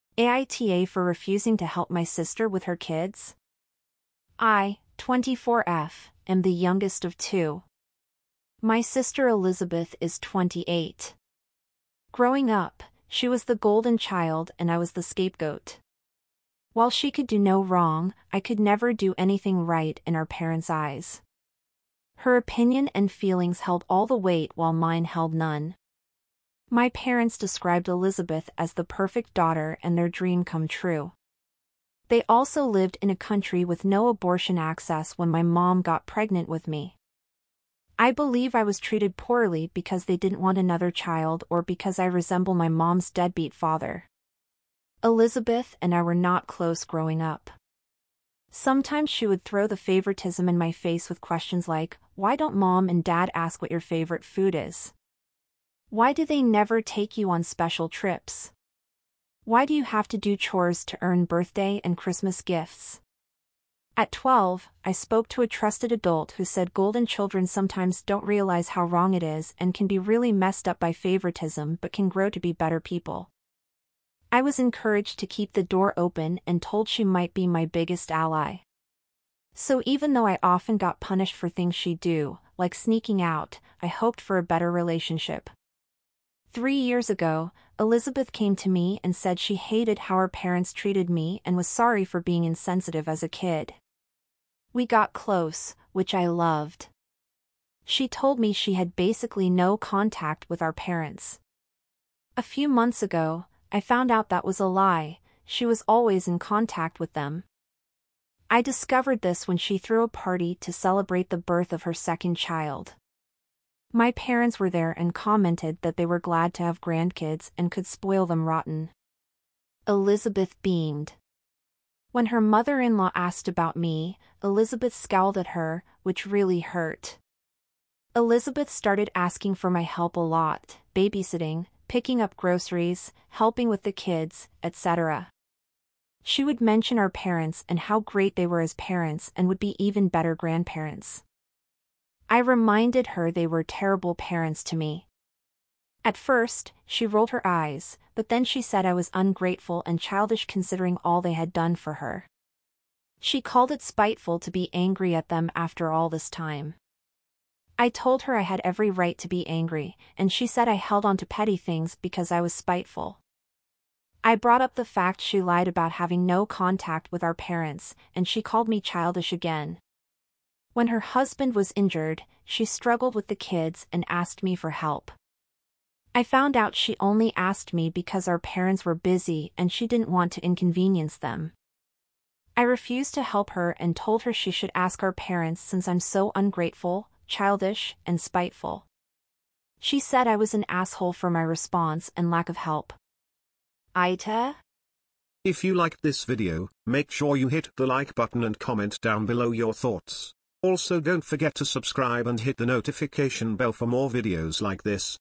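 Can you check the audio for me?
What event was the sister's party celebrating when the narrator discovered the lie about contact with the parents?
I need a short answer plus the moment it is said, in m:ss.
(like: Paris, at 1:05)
birth of her second child, at 1:51.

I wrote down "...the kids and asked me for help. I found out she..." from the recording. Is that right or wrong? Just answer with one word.
right.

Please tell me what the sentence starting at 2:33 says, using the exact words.
She called it spiteful to be angry at them after all this time.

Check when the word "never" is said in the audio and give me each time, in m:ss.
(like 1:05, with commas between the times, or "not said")
0:18, 0:56.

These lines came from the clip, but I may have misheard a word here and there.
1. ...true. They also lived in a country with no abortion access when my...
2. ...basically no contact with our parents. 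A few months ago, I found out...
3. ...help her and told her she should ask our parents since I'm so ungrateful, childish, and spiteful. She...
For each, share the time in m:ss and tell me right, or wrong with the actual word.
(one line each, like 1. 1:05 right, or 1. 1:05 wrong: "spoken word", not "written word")
1. 0:30 right
2. 1:38 right
3. 3:03 right.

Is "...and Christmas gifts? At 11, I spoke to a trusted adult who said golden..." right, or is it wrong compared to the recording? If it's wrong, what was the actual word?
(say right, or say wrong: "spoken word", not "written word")
wrong: "12", not "11".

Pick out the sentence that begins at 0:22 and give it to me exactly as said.
Her opinion and feelings held all the weight while mine held none.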